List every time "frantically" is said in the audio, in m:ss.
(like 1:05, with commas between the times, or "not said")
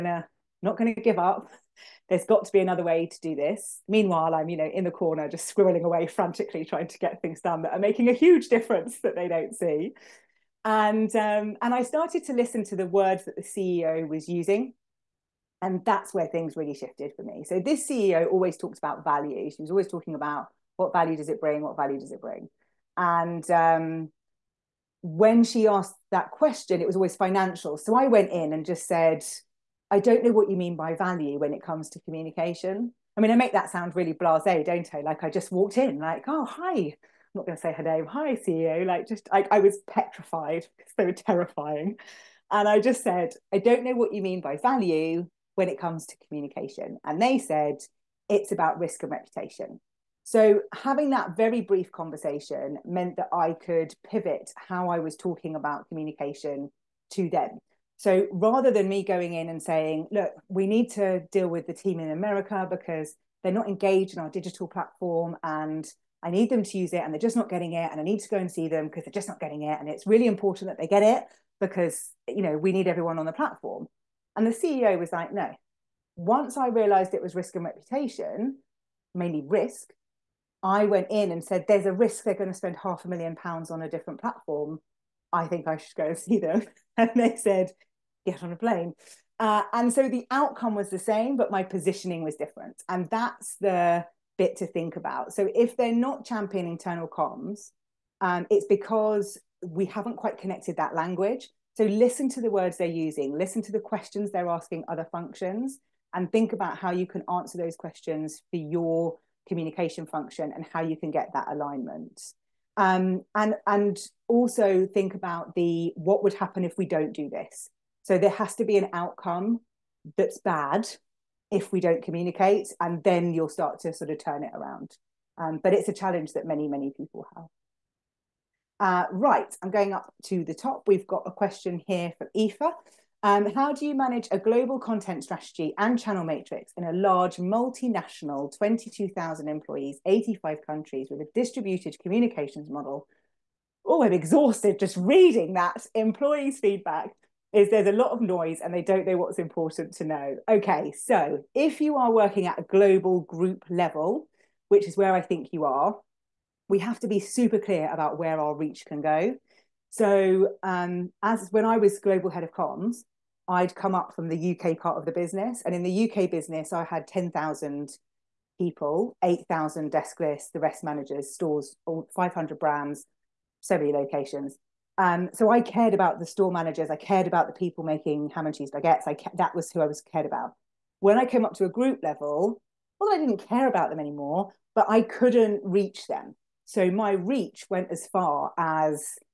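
0:06.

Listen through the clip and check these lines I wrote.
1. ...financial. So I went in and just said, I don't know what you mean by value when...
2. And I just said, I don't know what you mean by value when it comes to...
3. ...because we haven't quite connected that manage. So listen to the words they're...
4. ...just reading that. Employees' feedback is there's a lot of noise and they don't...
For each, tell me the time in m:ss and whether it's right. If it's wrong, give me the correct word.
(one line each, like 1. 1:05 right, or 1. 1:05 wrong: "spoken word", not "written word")
1. 0:27 right
2. 0:42 right
3. 1:38 wrong: "language", not "manage"
4. 2:24 right.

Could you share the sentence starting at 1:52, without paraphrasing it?
Um, and and also think about the what would happen if we don't do this.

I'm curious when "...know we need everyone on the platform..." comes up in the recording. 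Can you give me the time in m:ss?
1:12.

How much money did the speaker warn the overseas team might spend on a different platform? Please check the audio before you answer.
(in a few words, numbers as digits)
half a million pounds.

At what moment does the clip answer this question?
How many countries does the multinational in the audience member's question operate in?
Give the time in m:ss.
2:20.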